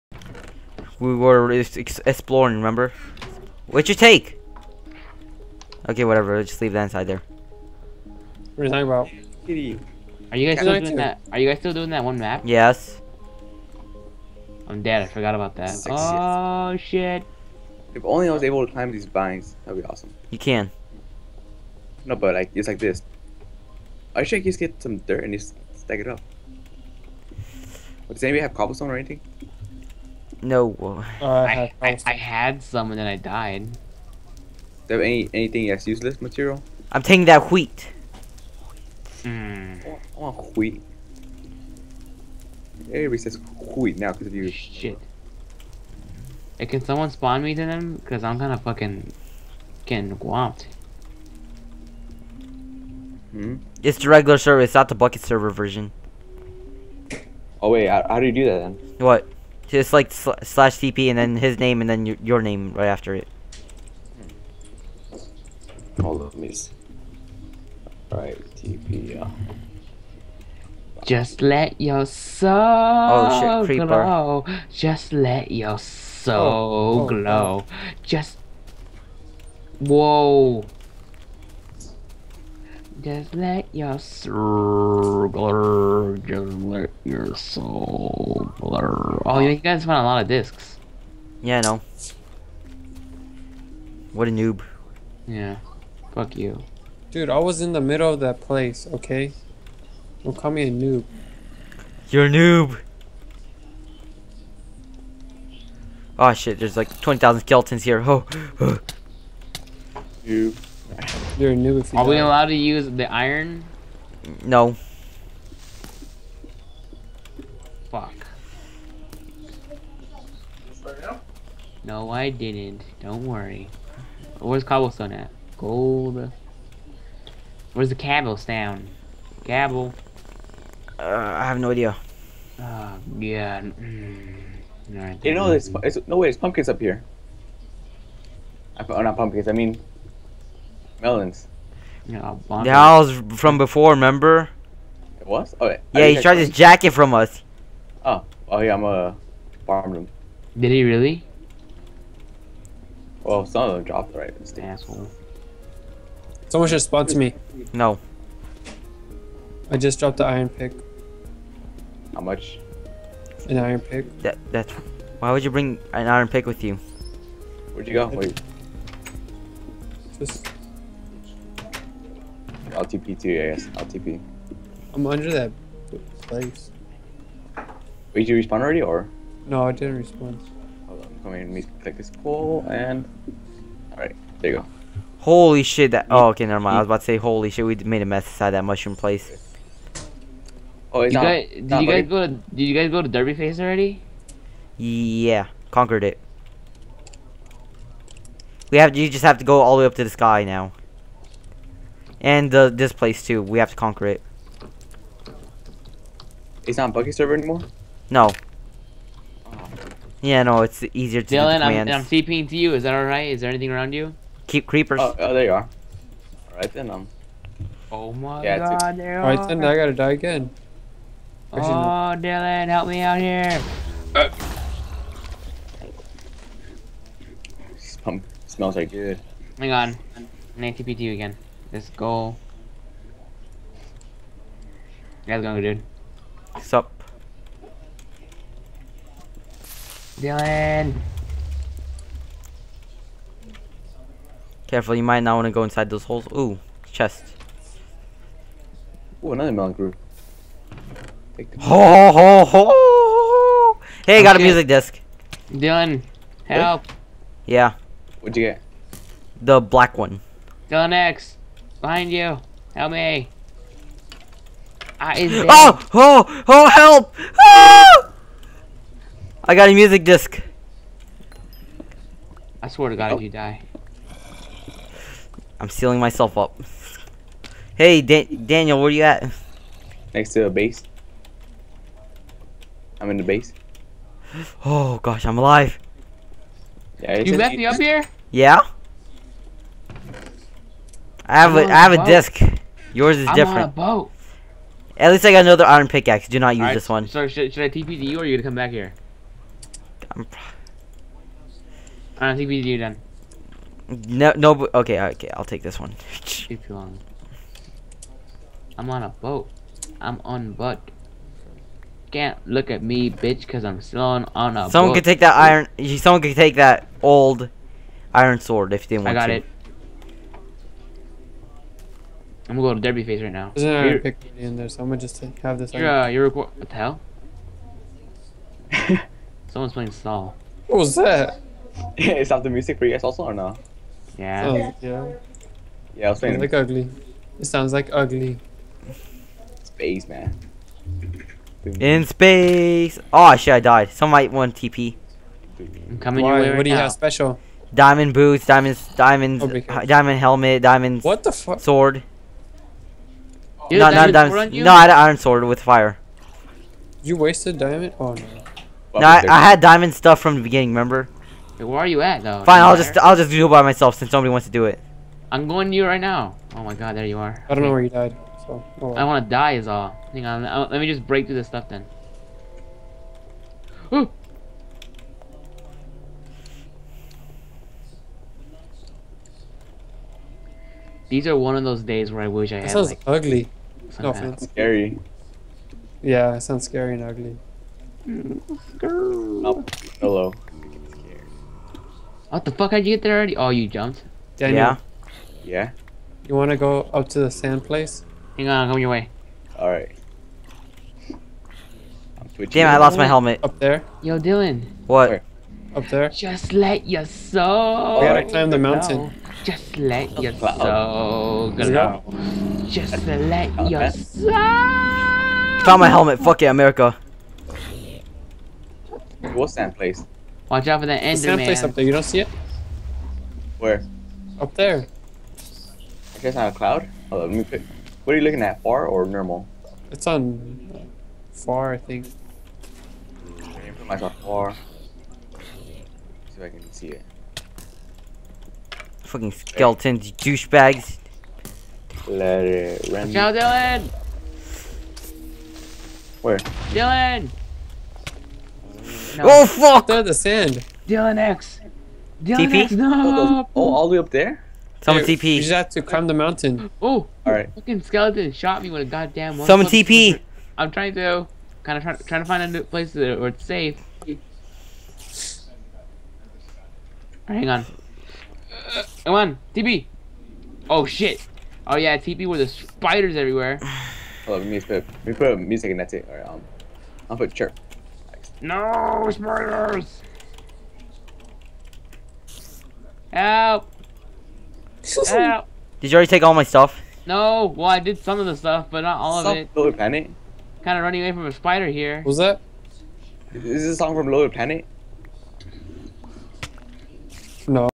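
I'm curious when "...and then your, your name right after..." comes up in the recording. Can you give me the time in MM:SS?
01:01.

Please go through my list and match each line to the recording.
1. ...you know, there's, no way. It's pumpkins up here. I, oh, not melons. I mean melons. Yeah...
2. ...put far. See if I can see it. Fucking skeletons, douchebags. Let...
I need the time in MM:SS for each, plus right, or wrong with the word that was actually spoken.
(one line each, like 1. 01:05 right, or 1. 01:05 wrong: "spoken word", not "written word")
1. 02:15 wrong: "pumpkins", not "melons"
2. 07:13 right.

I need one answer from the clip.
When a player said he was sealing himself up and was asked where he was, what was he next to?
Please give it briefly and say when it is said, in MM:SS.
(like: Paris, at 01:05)
a base, at 04:40.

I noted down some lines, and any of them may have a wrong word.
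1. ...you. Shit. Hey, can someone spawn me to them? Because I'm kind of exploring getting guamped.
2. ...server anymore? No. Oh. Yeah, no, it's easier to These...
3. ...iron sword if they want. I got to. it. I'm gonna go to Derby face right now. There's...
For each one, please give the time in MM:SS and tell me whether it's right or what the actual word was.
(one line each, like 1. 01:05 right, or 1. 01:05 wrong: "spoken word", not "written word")
1. 00:44 wrong: "fucking", not "exploring"
2. 03:27 wrong: "Dylan", not "These"
3. 05:18 right.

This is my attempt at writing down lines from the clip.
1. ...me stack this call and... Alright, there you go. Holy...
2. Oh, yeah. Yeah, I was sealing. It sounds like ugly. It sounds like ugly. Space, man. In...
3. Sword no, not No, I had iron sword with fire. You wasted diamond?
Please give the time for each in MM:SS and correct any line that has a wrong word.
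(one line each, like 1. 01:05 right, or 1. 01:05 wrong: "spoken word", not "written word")
1. 03:01 wrong: "click", not "stack"
2. 05:34 wrong: "playing", not "sealing"
3. 05:51 right.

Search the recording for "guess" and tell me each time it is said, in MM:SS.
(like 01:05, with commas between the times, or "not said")
02:53, 07:06.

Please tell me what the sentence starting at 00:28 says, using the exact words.
Does anybody have cobblestone or anything?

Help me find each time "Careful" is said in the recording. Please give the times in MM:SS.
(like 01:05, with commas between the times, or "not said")
04:04.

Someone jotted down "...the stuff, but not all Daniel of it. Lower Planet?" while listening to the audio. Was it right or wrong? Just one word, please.
wrong.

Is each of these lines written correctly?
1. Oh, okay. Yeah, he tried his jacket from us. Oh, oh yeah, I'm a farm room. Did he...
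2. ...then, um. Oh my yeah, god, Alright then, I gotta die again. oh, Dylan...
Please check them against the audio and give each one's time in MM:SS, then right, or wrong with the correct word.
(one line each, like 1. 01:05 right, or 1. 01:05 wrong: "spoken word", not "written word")
1. 02:25 right
2. 03:36 right.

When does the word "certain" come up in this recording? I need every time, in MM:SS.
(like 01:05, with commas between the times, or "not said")
not said.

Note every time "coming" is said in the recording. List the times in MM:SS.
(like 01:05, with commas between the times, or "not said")
03:01, 05:45, 06:38.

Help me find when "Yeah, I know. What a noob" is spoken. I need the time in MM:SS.
01:31.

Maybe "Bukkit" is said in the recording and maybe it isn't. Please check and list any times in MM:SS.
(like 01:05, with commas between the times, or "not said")
00:54, 03:26.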